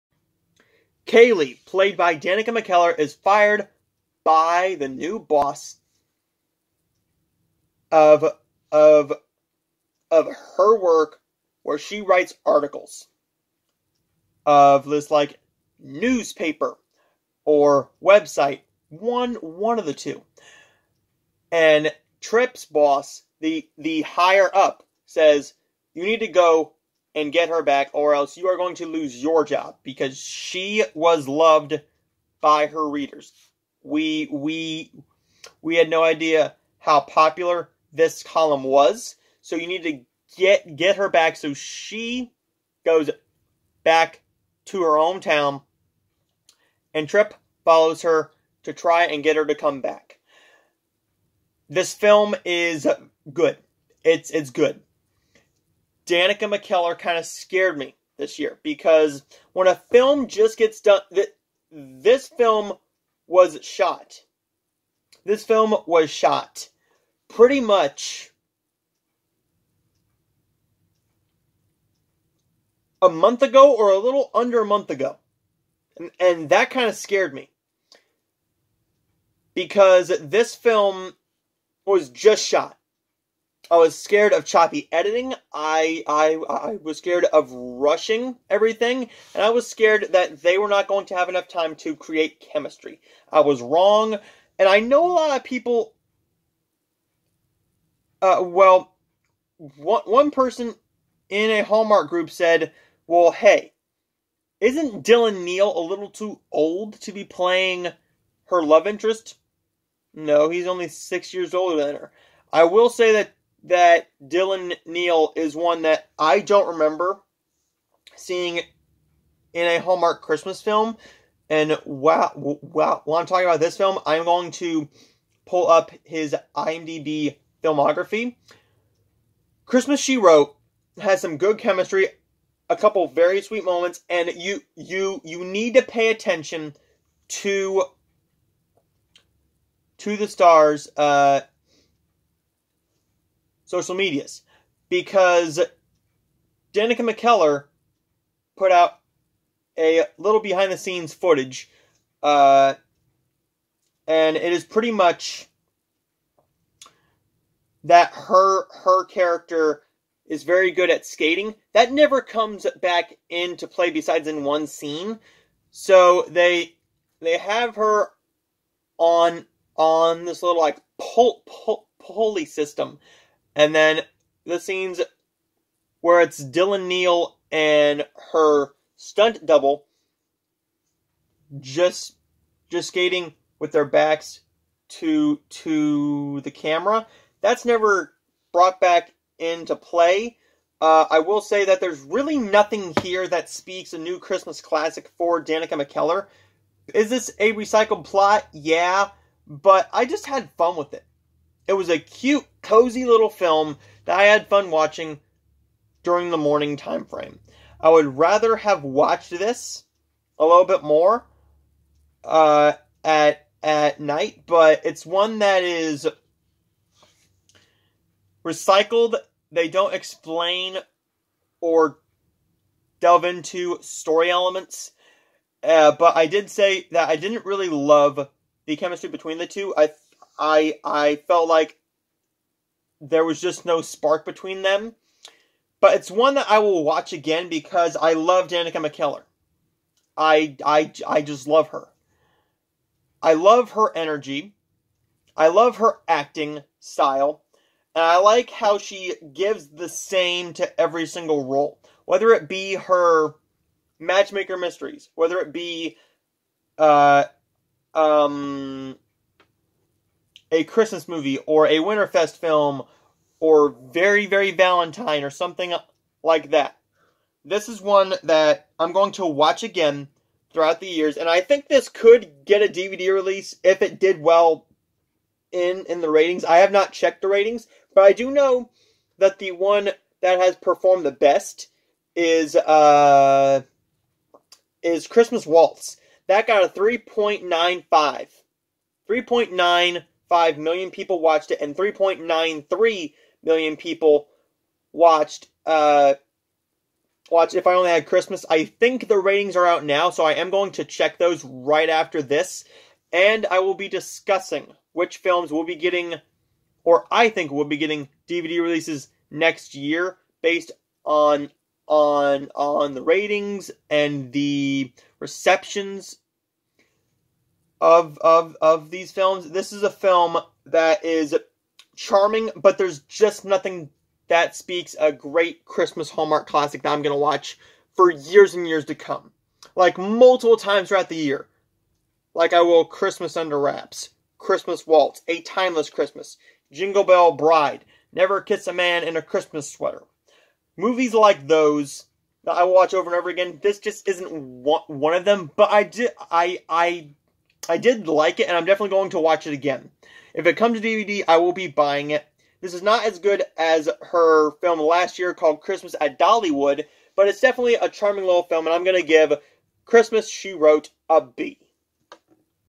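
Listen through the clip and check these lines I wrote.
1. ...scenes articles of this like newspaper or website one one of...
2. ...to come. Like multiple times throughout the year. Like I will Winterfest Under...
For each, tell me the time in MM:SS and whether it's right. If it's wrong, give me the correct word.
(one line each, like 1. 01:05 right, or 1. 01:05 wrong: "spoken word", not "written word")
1. 00:12 wrong: "writes", not "scenes"
2. 05:28 wrong: "Christmas", not "Winterfest".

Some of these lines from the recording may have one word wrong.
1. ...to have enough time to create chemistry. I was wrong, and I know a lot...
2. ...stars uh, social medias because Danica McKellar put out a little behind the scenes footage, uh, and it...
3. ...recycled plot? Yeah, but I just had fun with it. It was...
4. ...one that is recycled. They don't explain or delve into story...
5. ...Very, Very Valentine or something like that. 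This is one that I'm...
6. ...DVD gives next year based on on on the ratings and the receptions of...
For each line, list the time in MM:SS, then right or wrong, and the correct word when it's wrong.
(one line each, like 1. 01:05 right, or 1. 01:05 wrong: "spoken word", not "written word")
1. 01:31 right
2. 02:20 right
3. 03:17 right
4. 03:35 right
5. 04:23 right
6. 05:08 wrong: "releases", not "gives".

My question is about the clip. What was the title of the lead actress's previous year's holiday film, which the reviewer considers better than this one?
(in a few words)
Christmas at Dollywood.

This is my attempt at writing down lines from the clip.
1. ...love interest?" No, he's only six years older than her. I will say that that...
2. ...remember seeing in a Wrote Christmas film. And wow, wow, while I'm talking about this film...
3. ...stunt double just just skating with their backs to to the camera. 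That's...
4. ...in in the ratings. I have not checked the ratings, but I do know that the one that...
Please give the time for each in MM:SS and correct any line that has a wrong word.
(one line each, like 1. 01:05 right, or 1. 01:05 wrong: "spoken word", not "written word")
1. 01:48 right
2. 01:56 wrong: "Hallmark", not "Wrote"
3. 02:58 right
4. 04:35 right.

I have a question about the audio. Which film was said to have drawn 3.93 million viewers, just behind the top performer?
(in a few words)
If I Only Had Christmas.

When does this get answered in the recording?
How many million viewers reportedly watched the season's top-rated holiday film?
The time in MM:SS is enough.
04:46.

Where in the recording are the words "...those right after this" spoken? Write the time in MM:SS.
05:01.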